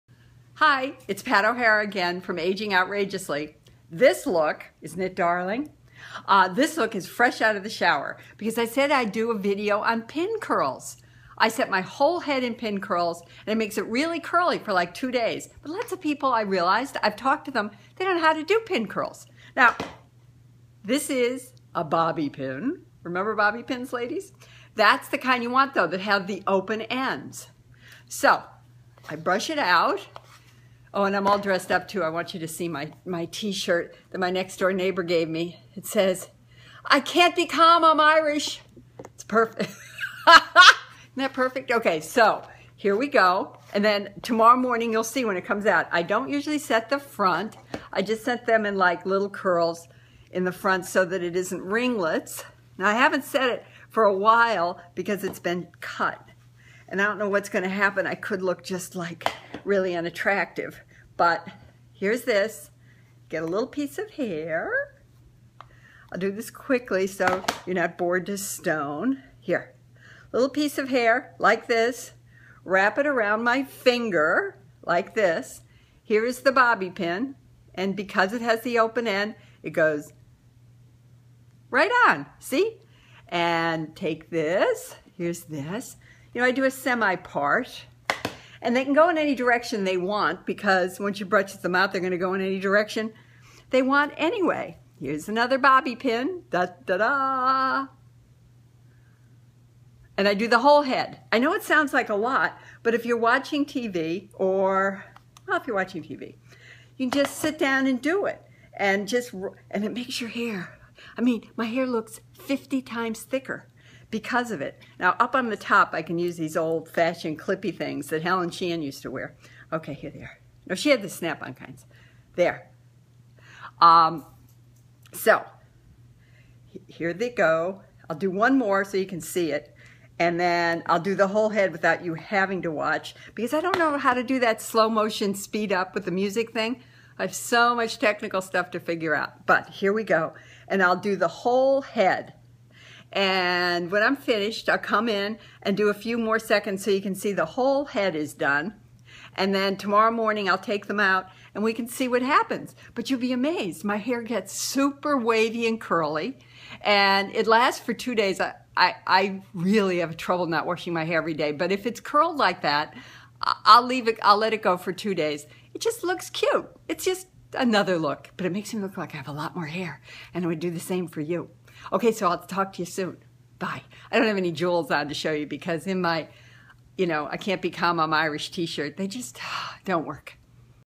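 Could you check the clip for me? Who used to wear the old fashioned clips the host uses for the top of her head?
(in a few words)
Helen Sheehan.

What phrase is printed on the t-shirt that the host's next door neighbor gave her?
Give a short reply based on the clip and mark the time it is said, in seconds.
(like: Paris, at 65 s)
I can't be calm, I'm Irish, at 36 s.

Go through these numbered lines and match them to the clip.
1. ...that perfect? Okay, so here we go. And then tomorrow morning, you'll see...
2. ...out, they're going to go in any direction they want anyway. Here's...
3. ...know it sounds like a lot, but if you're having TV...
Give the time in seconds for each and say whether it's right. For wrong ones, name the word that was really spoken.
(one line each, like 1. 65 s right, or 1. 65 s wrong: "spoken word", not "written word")
1. 41 s right
2. 91 s right
3. 101 s wrong: "watching", not "having".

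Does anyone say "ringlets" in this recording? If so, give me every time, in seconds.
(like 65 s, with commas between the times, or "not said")
51 s.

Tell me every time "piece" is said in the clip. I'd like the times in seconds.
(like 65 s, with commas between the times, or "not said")
63 s, 70 s.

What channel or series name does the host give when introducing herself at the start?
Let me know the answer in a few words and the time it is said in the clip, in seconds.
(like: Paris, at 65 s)
Aging Outrageously, at 2 s.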